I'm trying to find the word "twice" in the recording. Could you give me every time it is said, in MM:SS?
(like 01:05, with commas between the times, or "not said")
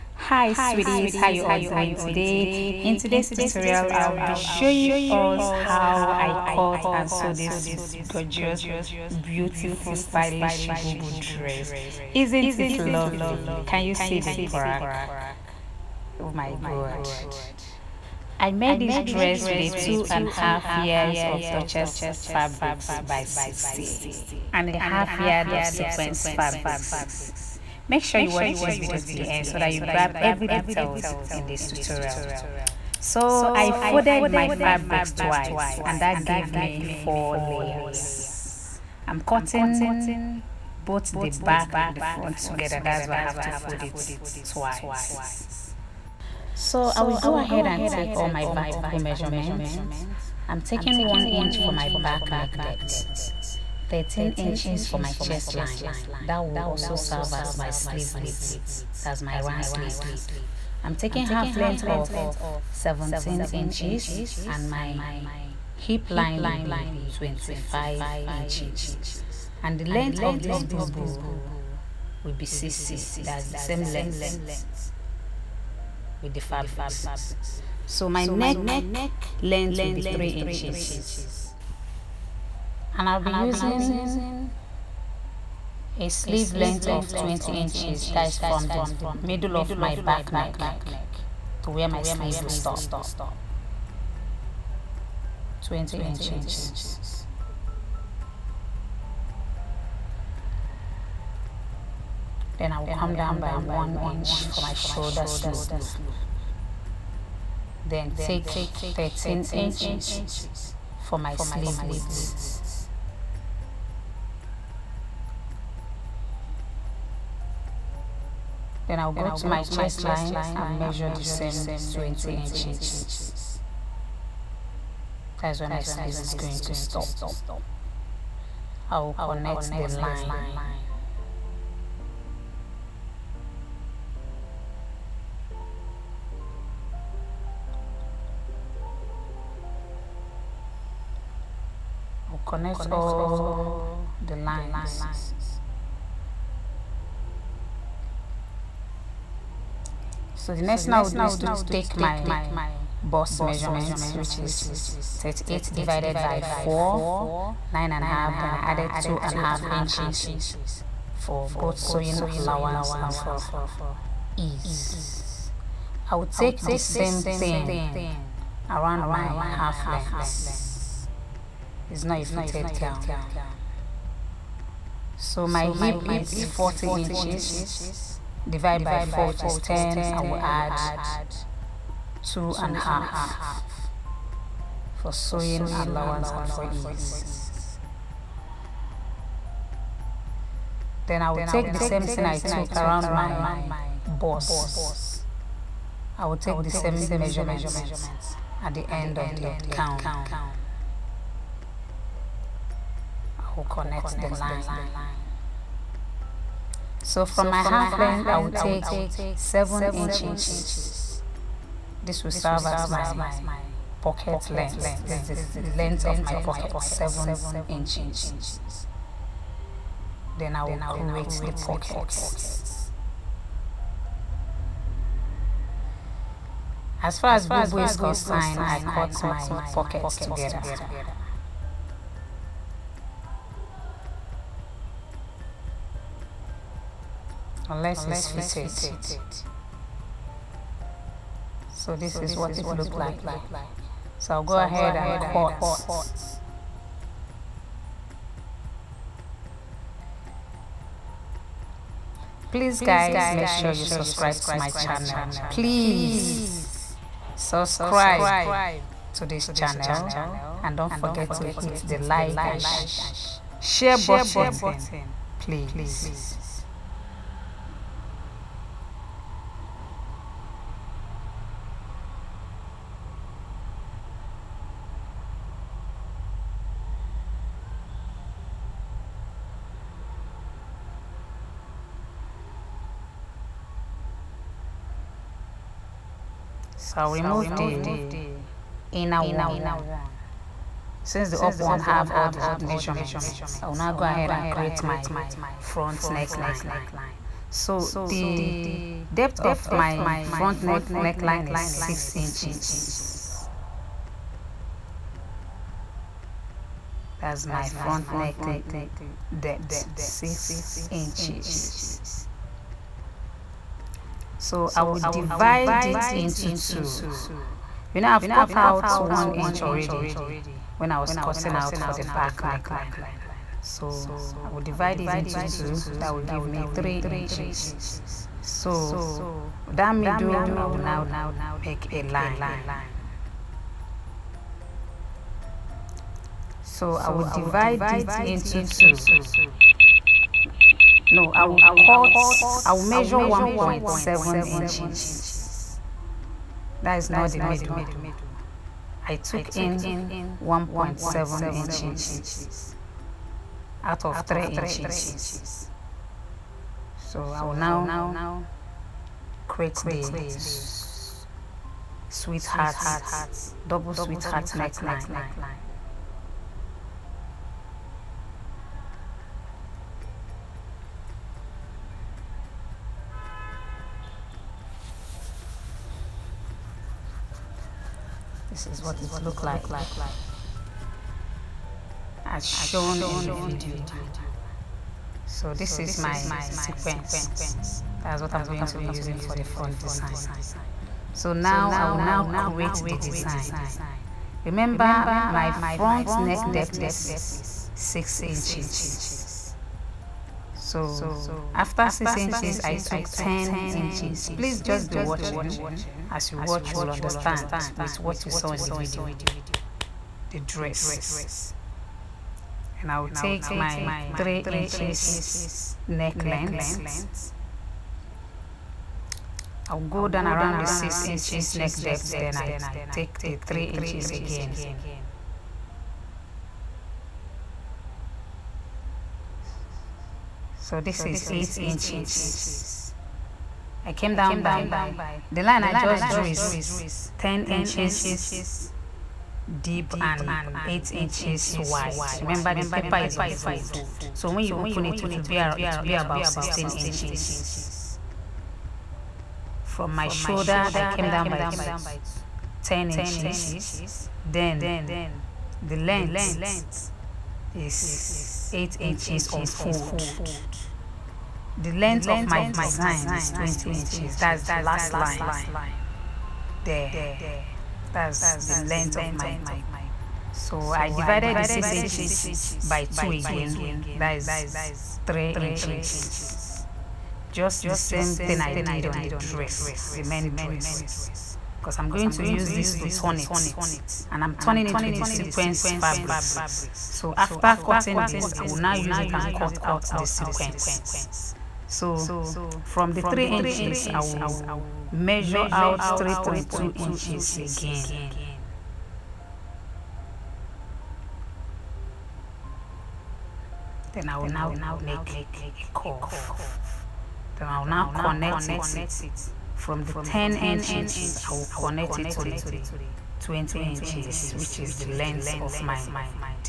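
00:35, 00:44.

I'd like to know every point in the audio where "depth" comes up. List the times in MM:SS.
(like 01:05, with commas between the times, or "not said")
00:52, 04:59, 05:09, 06:36, 07:01.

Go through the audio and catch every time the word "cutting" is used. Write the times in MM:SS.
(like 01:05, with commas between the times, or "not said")
00:39, 05:21, 08:07.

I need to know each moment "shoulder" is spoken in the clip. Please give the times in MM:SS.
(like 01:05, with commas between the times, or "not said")
01:44, 07:30.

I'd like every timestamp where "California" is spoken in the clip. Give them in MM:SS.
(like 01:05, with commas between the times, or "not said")
not said.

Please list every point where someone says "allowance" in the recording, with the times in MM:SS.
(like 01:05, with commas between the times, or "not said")
02:42, 03:05.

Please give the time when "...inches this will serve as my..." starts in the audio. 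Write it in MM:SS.
03:29.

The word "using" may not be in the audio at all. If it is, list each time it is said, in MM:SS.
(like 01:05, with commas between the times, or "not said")
01:23, 06:28.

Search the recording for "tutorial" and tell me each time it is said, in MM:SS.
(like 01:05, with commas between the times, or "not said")
00:03, 00:31.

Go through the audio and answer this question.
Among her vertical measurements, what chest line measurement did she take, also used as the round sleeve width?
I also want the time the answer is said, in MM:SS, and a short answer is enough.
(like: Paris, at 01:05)
13 inches, at 00:53.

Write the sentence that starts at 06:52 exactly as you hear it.
And I will take my 3 inches neck length.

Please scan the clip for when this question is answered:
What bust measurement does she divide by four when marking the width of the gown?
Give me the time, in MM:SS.
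02:35.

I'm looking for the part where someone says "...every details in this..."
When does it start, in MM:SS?
00:30.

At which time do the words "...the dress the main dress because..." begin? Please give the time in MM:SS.
07:59.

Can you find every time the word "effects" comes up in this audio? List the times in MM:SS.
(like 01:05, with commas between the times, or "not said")
not said.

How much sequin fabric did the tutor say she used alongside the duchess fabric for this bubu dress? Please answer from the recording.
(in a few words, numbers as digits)
half yard.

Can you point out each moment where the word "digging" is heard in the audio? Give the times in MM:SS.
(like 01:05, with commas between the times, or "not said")
not said.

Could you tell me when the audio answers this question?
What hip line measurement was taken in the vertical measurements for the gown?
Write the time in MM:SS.
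01:07.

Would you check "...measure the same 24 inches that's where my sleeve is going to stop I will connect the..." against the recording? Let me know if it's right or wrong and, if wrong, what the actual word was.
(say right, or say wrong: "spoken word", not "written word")
wrong: "20", not "24".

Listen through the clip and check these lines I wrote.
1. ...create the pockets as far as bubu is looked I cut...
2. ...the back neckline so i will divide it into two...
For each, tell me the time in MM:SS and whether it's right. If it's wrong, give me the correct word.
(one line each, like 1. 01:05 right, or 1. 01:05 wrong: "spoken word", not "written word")
1. 03:40 wrong: "concerned", not "looked"
2. 05:21 right.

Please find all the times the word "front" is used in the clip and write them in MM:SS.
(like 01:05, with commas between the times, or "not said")
00:42, 04:55, 05:00, 05:07, 06:29, 06:35.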